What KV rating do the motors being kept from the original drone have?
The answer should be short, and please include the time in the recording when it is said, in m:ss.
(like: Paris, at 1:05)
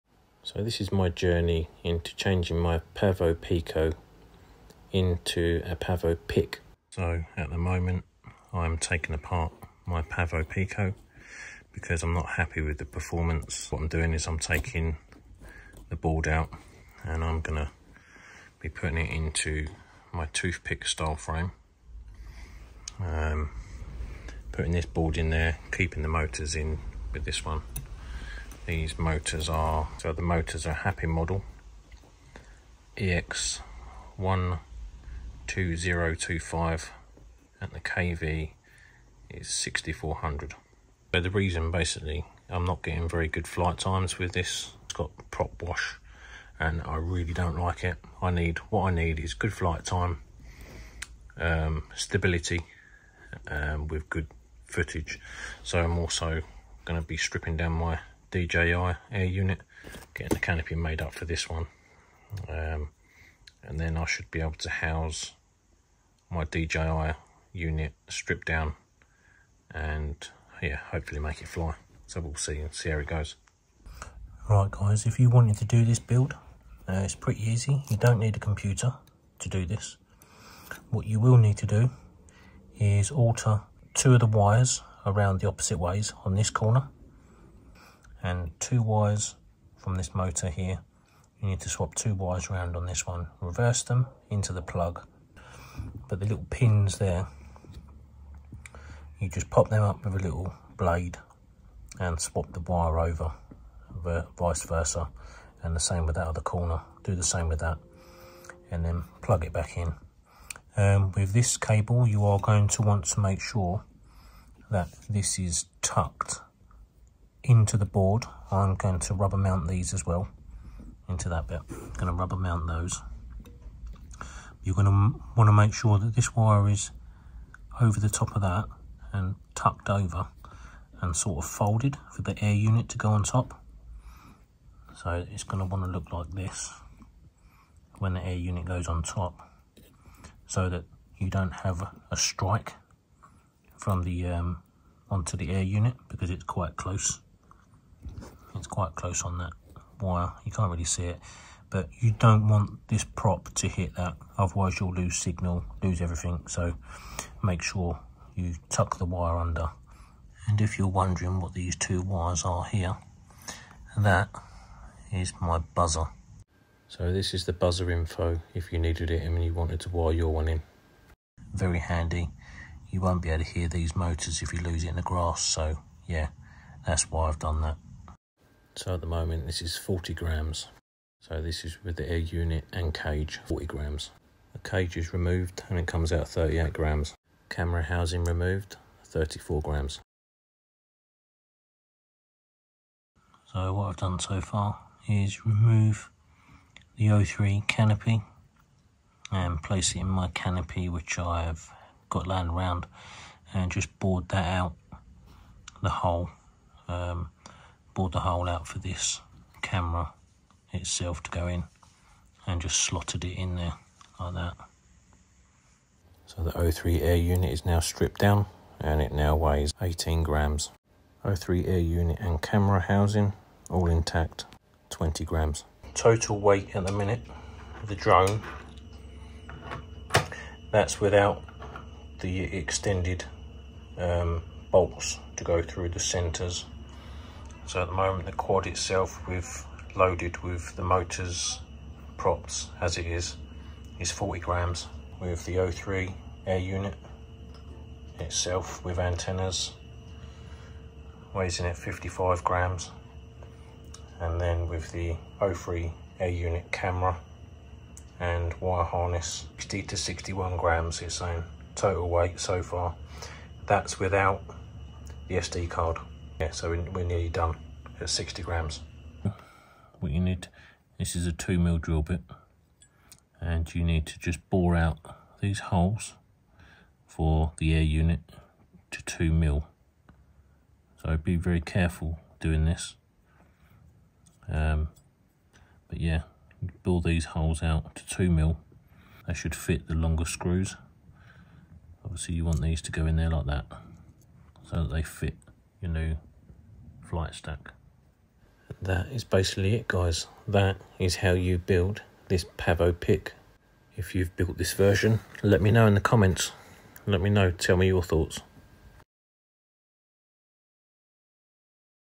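6400, at 0:39.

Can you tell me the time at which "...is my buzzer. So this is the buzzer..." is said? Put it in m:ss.
2:45.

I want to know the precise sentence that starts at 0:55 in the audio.
So I'm also going to be stripping down my DJI air unit, getting the canopy made up for this one.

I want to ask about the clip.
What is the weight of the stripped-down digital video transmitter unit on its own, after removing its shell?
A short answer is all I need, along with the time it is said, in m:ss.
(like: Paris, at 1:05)
18 grams, at 3:39.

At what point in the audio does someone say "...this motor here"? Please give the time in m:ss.
1:29.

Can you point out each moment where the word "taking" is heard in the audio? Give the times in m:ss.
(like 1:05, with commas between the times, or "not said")
0:08, 0:14.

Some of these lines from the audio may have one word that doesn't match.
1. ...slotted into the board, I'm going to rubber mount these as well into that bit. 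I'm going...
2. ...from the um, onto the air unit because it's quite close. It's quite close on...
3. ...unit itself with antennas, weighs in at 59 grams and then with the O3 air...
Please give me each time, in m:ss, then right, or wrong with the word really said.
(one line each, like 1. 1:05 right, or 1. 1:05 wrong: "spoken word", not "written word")
1. 1:55 wrong: "tucked", not "slotted"
2. 2:23 right
3. 4:06 wrong: "55", not "59".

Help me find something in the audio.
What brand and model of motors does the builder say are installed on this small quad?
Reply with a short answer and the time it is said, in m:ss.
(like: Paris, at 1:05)
Happy Model EX12025, at 0:30.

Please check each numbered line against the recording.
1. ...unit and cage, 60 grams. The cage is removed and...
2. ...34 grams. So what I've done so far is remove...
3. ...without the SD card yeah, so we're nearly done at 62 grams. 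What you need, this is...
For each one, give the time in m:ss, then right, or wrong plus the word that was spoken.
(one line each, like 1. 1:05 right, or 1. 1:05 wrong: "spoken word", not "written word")
1. 3:02 wrong: "40", not "60"
2. 3:09 right
3. 4:23 wrong: "60", not "62".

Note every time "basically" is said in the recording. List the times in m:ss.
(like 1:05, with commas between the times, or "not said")
0:41, 4:59.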